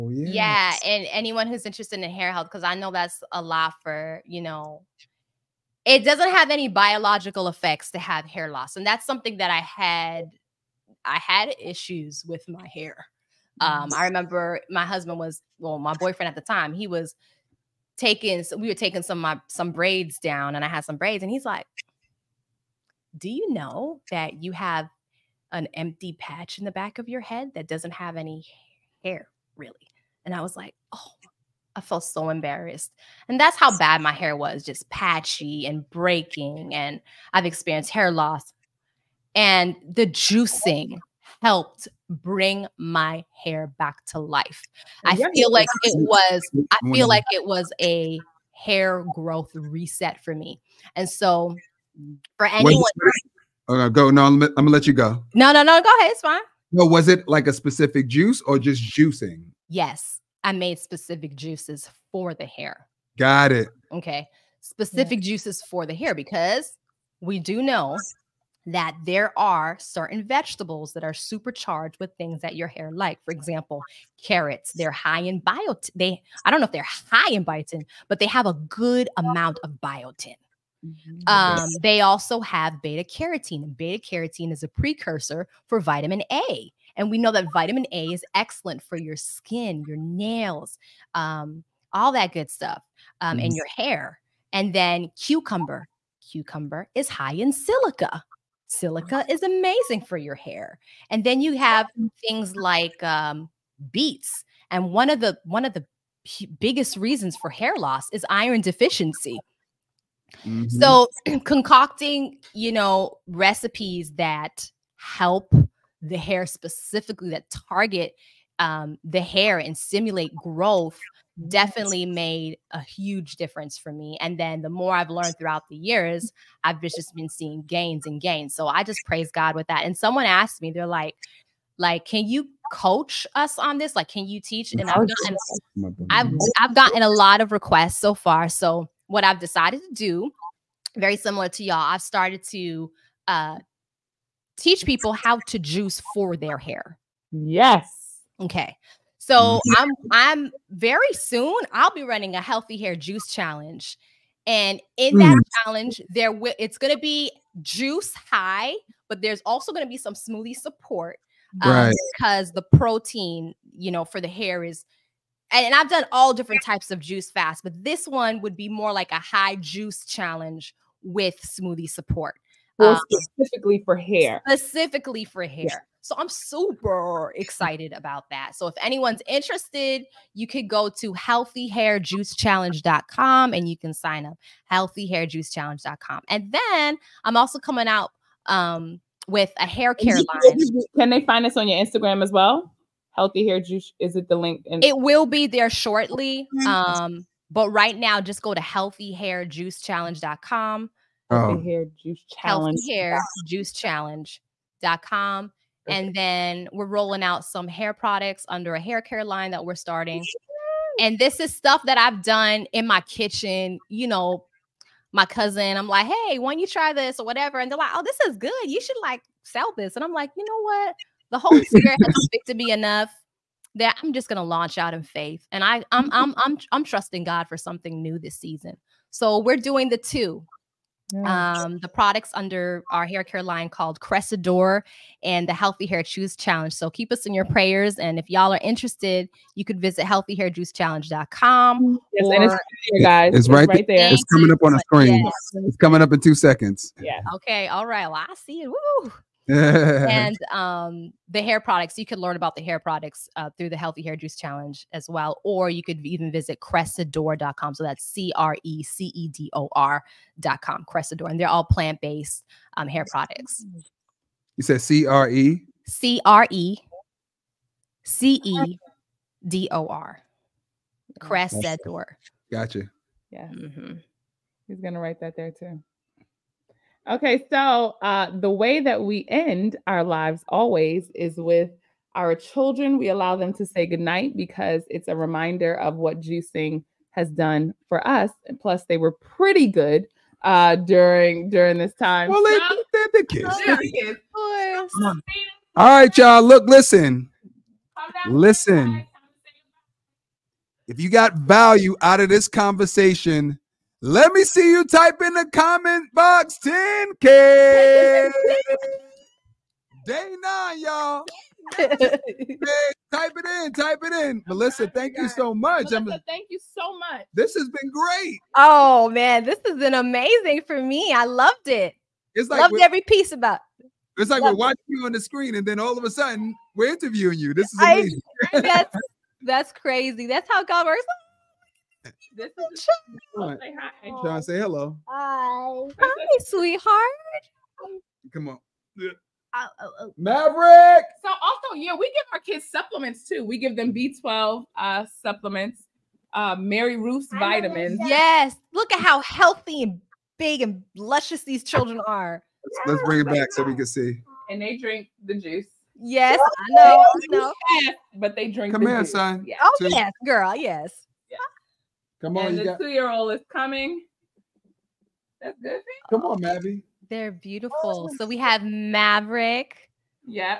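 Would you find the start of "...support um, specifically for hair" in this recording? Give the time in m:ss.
2:51.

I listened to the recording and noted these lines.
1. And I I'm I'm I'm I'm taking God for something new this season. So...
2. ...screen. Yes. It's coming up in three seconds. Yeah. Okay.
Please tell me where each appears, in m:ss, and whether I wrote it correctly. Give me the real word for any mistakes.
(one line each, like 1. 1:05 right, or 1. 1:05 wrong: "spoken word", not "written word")
1. 3:45 wrong: "trusting", not "taking"
2. 4:04 wrong: "two", not "three".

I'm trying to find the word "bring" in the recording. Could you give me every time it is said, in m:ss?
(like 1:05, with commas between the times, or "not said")
0:42, 5:53.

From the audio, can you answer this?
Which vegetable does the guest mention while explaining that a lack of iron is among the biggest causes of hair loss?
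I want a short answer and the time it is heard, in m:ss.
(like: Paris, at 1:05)
Beets, at 1:43.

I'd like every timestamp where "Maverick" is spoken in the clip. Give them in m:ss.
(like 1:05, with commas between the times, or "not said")
5:40, 6:08.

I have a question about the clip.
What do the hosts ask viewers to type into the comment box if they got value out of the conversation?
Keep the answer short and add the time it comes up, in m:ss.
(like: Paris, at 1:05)
10K, at 5:06.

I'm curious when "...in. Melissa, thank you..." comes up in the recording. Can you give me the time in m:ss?
5:14.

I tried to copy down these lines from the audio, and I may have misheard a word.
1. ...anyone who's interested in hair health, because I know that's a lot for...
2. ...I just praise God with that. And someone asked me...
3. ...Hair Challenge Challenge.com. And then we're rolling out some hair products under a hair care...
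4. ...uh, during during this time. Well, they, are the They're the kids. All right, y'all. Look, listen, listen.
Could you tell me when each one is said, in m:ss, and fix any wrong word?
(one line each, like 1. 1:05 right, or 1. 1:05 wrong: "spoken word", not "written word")
1. 0:01 right
2. 2:08 right
3. 3:22 wrong: "Juice", not "Challenge"
4. 4:50 right.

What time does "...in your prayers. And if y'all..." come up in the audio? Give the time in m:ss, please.
3:57.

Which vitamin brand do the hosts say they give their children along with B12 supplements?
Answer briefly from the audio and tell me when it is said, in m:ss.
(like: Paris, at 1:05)
Mary Ruth's, at 5:46.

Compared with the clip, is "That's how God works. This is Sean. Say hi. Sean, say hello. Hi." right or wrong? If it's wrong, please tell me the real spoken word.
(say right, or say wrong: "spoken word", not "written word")
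right.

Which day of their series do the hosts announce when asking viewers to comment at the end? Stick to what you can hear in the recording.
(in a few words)
Day 9.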